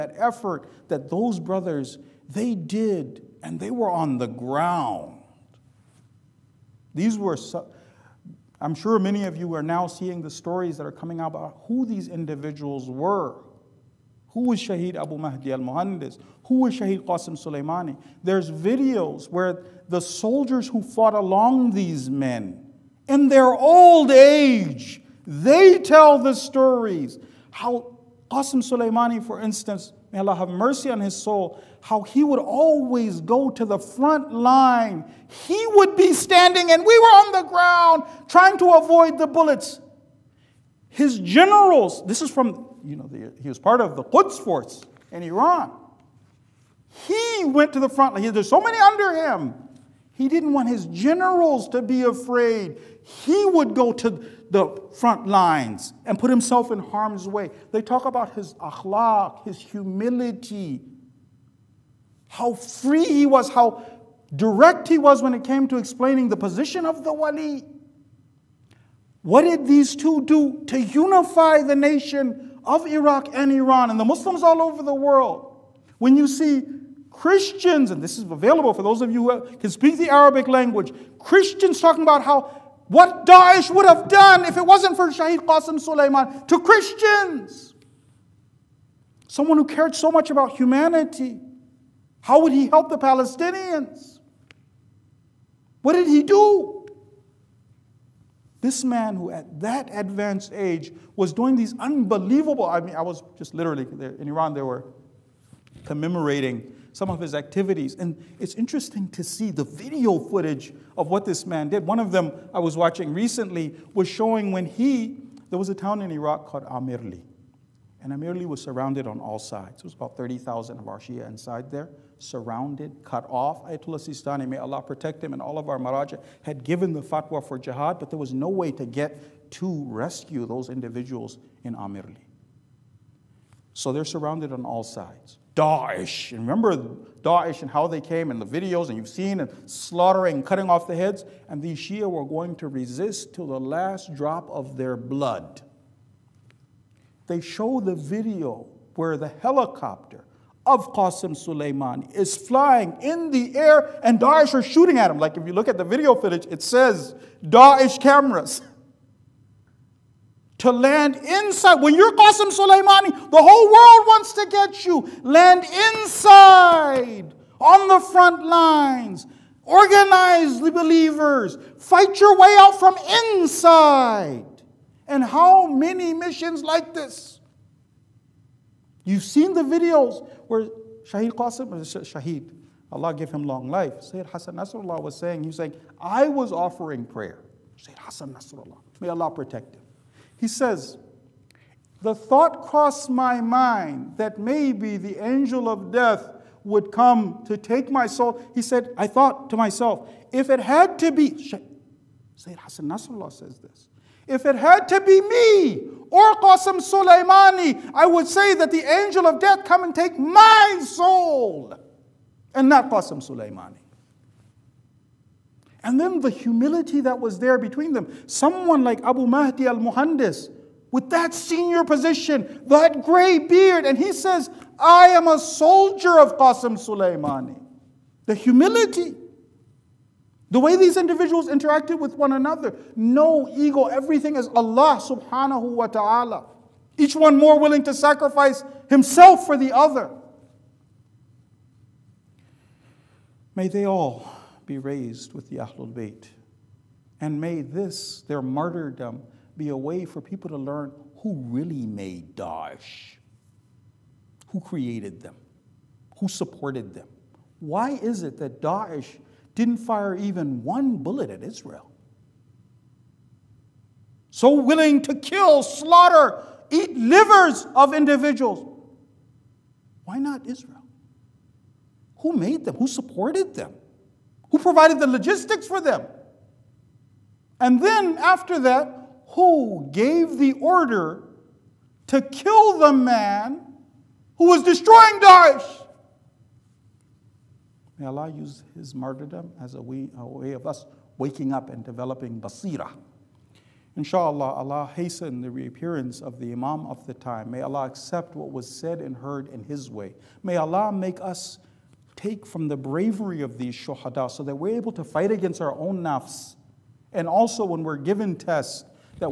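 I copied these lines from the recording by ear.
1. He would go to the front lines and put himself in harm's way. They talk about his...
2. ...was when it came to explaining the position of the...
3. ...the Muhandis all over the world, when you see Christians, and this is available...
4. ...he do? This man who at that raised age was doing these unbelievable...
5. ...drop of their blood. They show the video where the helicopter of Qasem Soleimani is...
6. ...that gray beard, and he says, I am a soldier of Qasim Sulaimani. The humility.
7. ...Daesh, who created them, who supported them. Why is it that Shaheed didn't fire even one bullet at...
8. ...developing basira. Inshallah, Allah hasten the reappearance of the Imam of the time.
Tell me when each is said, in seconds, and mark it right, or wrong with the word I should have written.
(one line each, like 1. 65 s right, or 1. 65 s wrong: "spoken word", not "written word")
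1. 53 s right
2. 64 s right
3. 73 s wrong: "Muslims", not "Muhandis"
4. 96 s wrong: "advanced", not "raised"
5. 144 s right
6. 222 s right
7. 252 s wrong: "Daesh", not "Shaheed"
8. 291 s right.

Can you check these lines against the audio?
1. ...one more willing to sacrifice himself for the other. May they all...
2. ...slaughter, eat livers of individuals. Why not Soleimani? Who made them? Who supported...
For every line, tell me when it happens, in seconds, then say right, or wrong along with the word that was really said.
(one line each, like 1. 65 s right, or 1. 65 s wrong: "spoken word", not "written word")
1. 237 s right
2. 265 s wrong: "Israel", not "Soleimani".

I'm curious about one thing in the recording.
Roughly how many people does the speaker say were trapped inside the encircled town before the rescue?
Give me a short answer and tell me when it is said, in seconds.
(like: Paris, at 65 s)
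30,000, at 120 s.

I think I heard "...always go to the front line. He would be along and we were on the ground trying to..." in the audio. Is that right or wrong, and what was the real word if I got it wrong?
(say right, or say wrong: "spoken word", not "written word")
wrong: "standing", not "along".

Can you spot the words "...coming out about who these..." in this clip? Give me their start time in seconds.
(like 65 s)
10 s.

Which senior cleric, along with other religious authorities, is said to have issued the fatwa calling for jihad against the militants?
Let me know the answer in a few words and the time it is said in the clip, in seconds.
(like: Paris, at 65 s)
Ayatollah Sistani, at 123 s.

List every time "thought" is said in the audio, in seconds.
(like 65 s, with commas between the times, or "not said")
192 s, 199 s.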